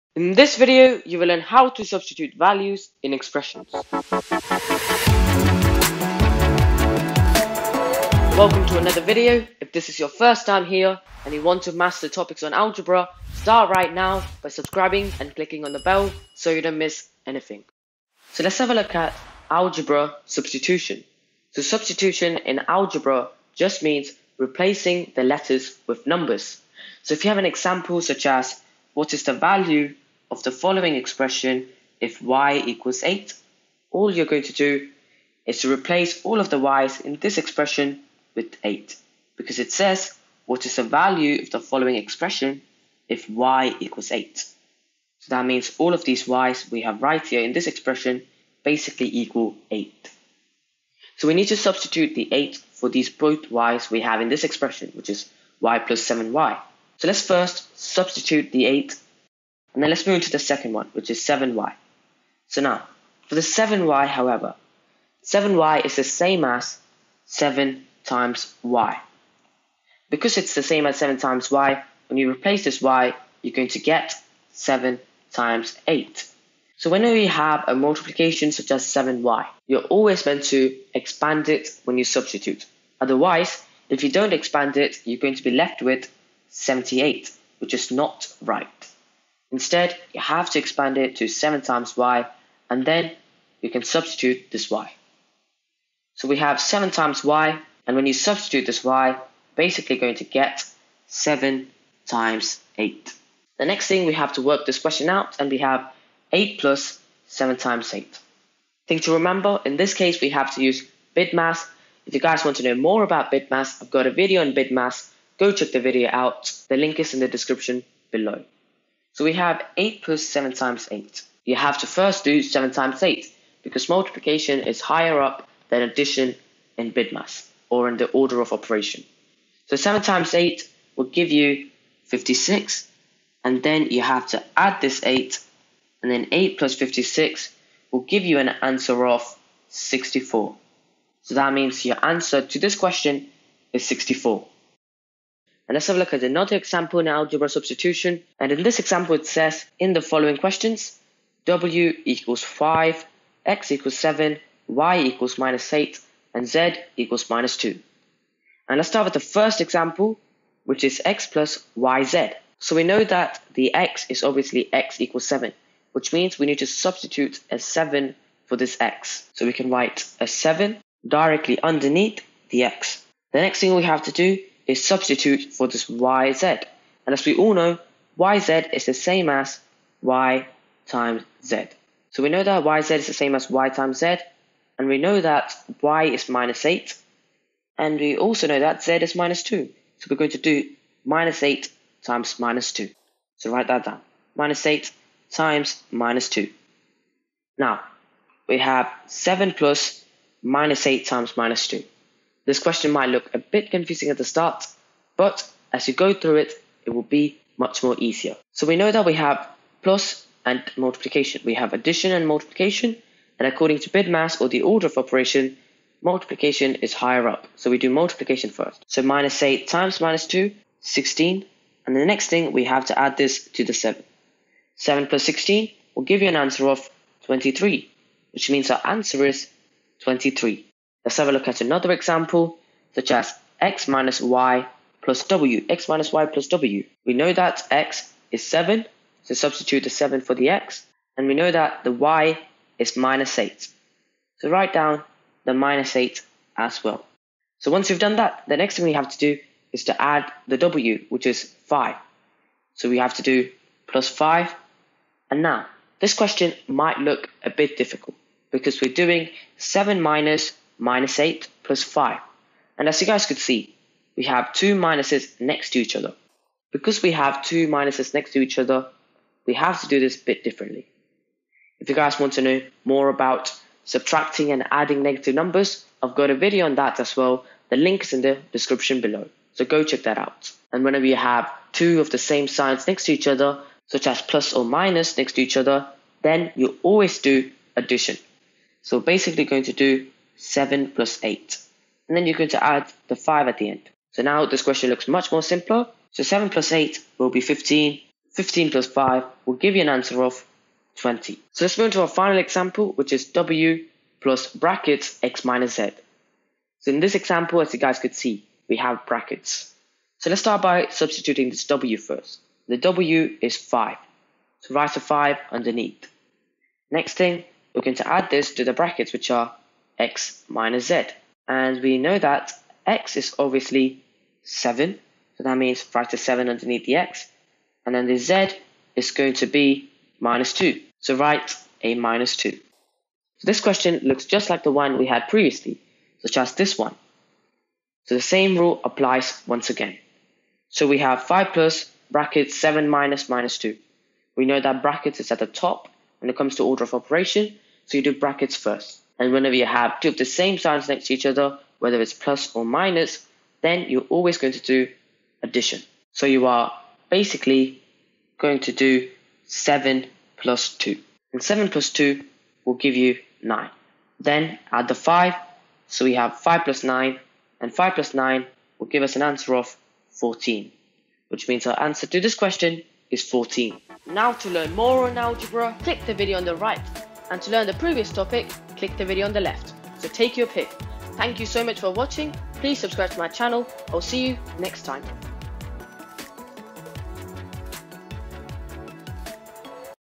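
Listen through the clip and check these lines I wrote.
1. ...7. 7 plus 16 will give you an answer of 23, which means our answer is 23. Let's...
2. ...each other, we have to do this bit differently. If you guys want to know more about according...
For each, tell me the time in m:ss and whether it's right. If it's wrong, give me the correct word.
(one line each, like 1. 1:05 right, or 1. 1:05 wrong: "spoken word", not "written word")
1. 3:43 right
2. 4:28 wrong: "subtracting", not "according".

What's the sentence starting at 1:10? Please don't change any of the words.
Because it's the same as 7 times y, when you replace this y, you're going to get 7 times 8.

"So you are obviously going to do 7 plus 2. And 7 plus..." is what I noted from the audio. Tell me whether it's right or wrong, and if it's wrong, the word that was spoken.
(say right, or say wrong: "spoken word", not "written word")
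wrong: "basically", not "obviously".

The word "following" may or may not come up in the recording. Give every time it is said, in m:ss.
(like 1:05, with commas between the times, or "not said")
0:30, 0:41, 2:30.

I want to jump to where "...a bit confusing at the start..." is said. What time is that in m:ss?
3:23.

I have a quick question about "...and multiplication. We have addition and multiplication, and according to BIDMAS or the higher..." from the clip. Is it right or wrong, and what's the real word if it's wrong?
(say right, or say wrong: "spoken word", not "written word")
wrong: "order", not "higher".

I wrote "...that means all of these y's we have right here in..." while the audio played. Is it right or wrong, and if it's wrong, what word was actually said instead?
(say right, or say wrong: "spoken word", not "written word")
right.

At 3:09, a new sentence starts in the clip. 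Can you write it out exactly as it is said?
So we're going to do minus 8 times minus 2.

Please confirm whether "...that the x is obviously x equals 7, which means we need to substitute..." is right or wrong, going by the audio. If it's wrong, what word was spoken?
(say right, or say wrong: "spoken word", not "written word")
right.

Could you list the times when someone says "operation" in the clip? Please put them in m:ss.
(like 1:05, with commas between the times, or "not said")
2:08, 3:34, 5:46.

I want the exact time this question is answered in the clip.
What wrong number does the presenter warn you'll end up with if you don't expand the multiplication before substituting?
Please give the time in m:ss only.
1:26.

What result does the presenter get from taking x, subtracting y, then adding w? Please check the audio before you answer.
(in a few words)
20.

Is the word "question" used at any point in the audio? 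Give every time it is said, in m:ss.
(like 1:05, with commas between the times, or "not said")
1:44, 2:22, 2:30, 3:22, 4:16, 4:54, 5:33, 6:12.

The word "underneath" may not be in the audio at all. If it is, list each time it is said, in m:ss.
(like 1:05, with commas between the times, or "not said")
2:51, 5:15, 5:26.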